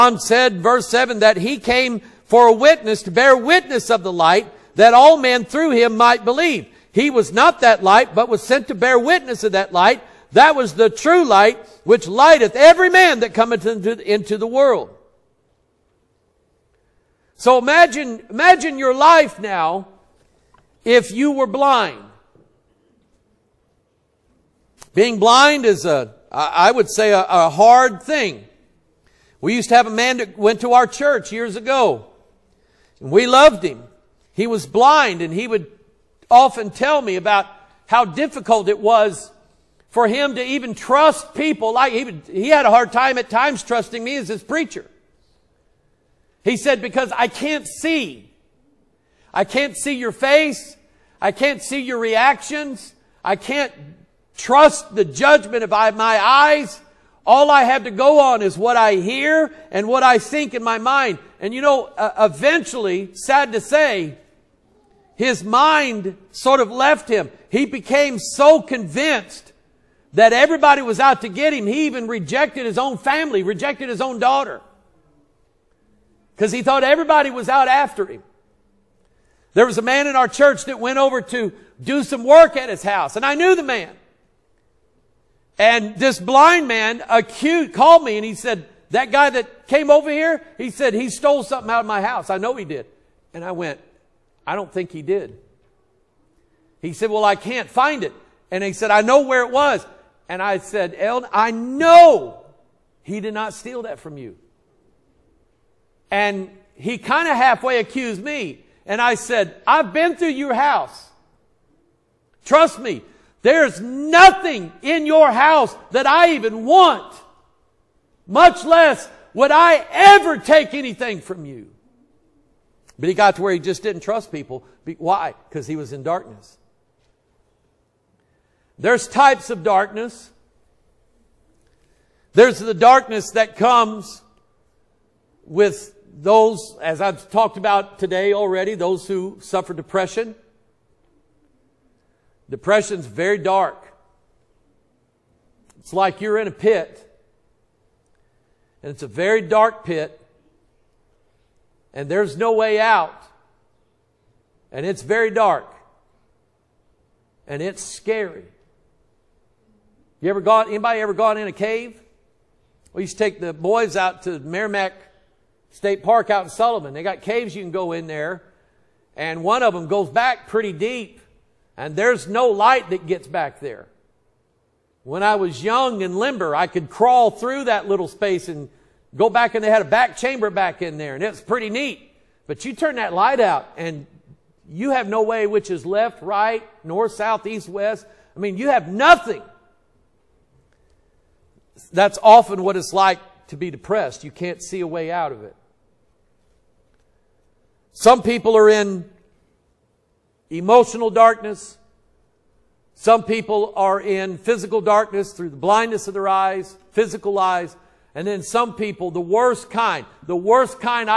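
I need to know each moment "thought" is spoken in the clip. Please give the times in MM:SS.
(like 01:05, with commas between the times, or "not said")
01:16.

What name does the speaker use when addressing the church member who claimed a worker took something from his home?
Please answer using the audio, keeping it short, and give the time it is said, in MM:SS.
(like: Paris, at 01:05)
El, at 01:40.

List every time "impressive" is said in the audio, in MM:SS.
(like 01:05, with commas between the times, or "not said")
not said.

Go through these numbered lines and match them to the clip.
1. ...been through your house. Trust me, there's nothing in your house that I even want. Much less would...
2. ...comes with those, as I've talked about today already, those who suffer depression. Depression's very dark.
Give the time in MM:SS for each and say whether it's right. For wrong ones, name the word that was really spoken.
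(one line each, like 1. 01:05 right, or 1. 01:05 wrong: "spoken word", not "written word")
1. 01:49 right
2. 02:13 right.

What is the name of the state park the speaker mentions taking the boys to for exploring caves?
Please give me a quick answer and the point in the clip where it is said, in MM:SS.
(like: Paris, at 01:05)
Meramec State Park, at 02:44.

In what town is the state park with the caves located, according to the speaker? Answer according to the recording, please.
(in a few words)
Sullivan.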